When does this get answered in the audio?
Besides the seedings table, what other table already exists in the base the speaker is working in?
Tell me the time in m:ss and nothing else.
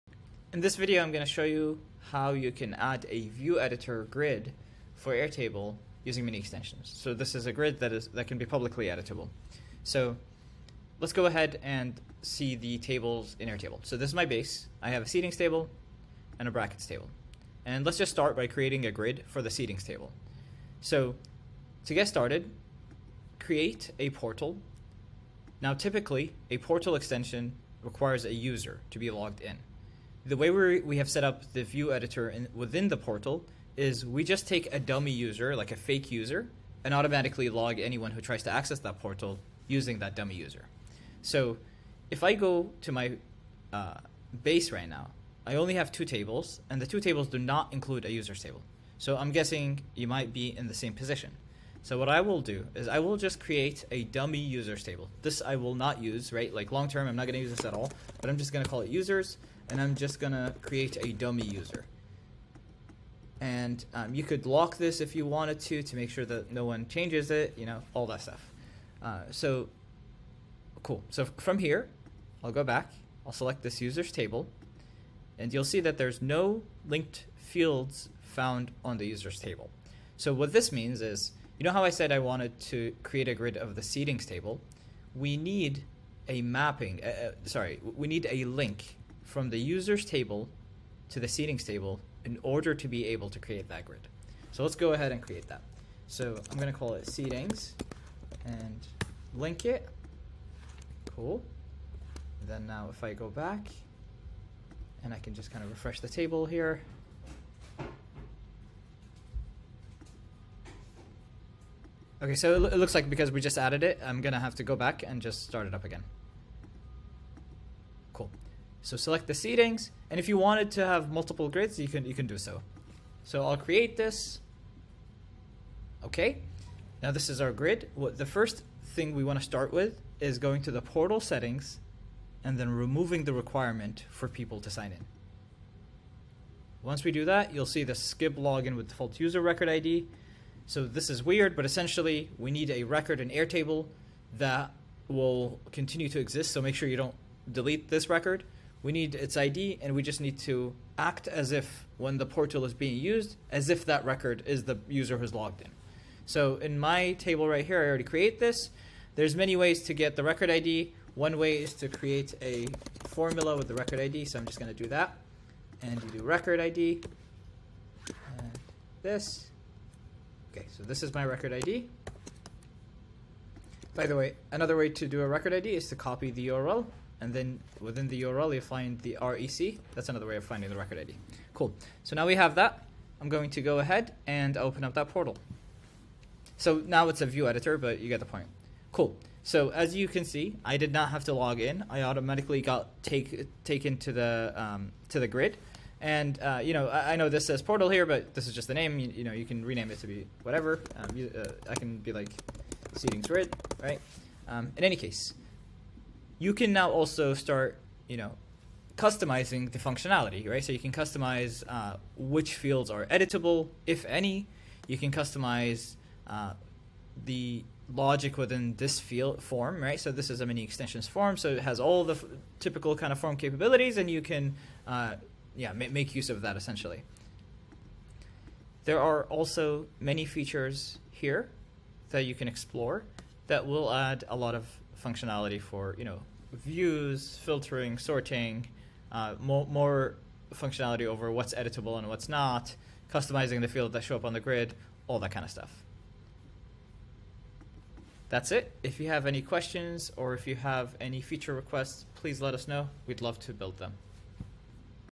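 0:16.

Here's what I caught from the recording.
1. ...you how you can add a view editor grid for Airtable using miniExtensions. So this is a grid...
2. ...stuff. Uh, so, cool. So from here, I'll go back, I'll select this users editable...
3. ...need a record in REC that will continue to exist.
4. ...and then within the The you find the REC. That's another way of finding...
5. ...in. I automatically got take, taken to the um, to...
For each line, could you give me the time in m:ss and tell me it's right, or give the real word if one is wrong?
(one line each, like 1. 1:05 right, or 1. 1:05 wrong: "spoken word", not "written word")
1. 0:01 right
2. 1:08 wrong: "table", not "editable"
3. 2:22 wrong: "Airtable", not "REC"
4. 2:57 wrong: "URL", not "The"
5. 3:11 right.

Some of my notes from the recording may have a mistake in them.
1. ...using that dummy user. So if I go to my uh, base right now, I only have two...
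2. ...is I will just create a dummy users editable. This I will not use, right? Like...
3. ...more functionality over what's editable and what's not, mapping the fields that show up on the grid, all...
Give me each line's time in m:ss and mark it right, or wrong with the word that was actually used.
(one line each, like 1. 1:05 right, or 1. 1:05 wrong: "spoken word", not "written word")
1. 0:39 right
2. 0:52 wrong: "table", not "editable"
3. 3:59 wrong: "customizing", not "mapping".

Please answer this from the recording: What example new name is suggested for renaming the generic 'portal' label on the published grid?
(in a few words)
Seedings grid.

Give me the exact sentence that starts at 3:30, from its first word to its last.
So you can customize uh, which fields are editable, if any.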